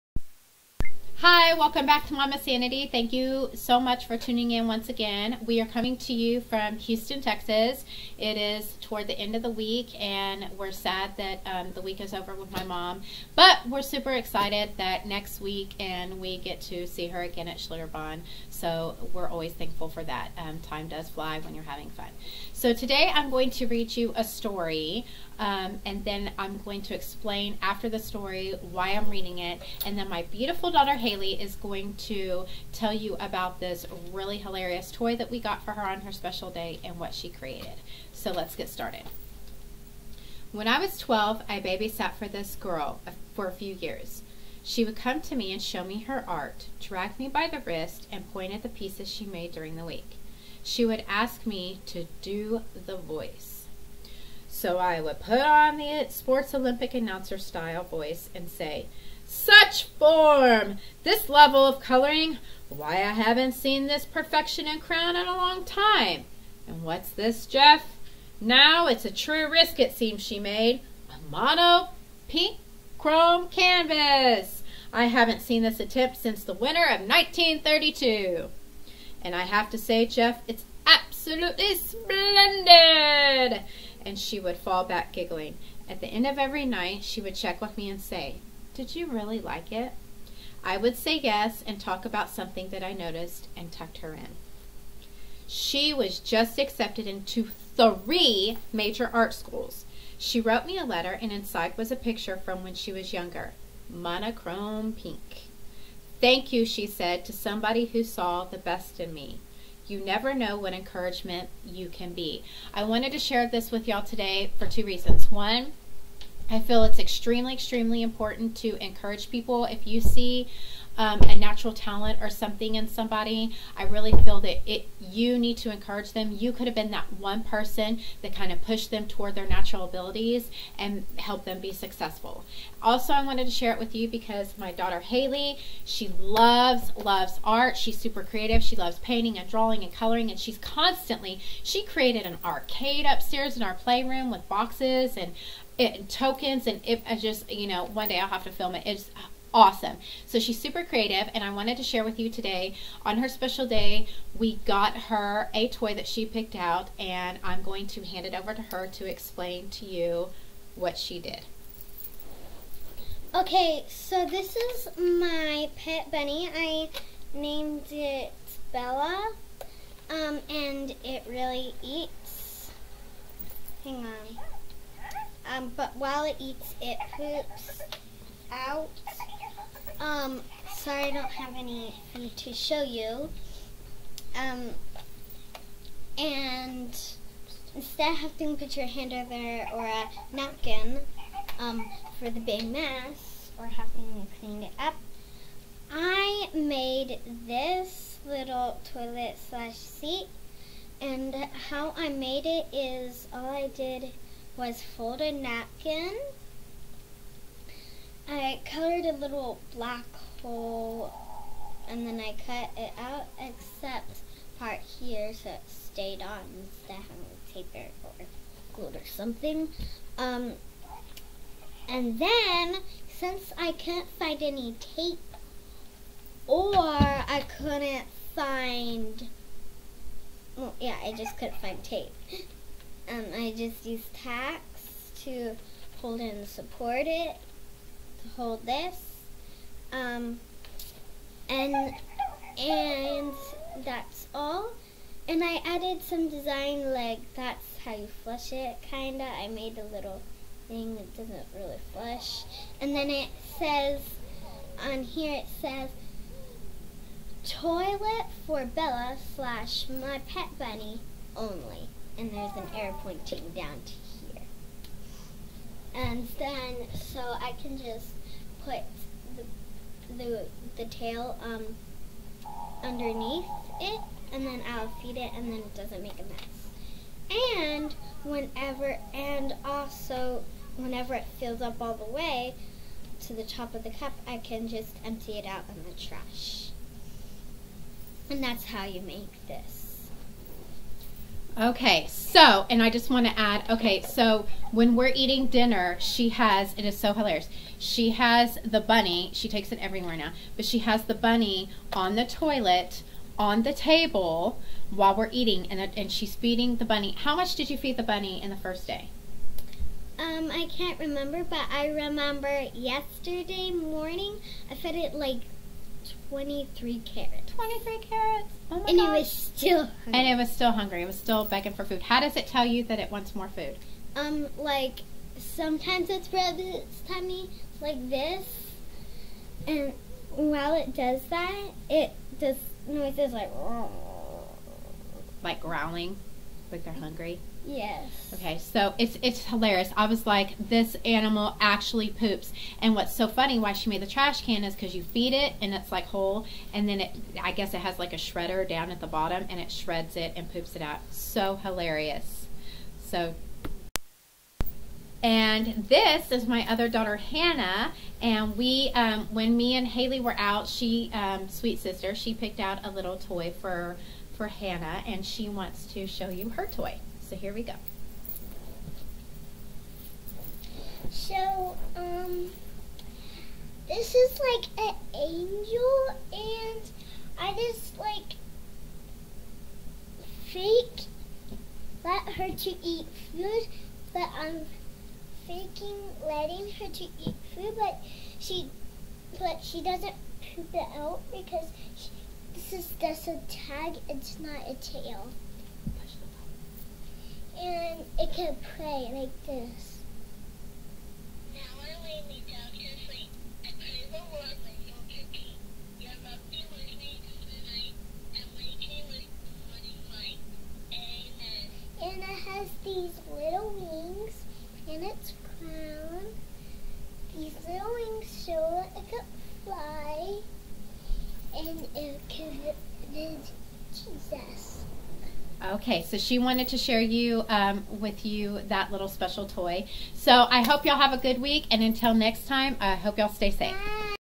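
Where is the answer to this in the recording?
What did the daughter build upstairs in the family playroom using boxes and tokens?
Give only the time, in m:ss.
2:22.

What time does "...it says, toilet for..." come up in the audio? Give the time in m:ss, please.
4:15.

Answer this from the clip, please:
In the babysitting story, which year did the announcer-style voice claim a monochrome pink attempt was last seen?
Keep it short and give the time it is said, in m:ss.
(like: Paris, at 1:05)
1932, at 1:16.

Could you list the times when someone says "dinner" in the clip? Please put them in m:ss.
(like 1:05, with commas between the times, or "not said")
4:55.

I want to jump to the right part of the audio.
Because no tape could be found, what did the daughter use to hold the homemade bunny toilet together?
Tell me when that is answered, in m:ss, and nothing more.
3:54.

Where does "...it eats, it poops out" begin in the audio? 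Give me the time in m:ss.
2:56.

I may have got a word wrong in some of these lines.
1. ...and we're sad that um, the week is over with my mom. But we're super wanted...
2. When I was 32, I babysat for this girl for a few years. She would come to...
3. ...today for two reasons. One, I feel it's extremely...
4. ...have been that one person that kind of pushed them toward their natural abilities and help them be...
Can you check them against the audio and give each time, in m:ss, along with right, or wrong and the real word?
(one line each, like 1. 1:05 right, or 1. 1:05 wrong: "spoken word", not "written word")
1. 0:10 wrong: "excited", not "wanted"
2. 0:40 wrong: "12", not "32"
3. 1:54 right
4. 2:06 right.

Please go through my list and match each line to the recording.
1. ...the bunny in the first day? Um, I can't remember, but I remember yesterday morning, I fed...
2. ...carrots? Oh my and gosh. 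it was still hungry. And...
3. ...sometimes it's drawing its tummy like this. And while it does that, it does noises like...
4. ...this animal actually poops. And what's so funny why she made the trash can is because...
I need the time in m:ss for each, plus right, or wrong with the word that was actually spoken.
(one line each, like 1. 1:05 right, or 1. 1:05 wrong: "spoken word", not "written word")
1. 5:07 right
2. 5:17 right
3. 5:25 wrong: "rubbing", not "drawing"
4. 5:40 right.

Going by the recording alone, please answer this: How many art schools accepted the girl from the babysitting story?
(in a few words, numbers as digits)
3.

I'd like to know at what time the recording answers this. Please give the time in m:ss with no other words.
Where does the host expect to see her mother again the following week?
0:17.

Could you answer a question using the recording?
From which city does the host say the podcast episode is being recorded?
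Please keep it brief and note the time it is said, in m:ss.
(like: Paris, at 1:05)
Houston, Texas, at 0:06.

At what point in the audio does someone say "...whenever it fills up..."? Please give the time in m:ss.
4:40.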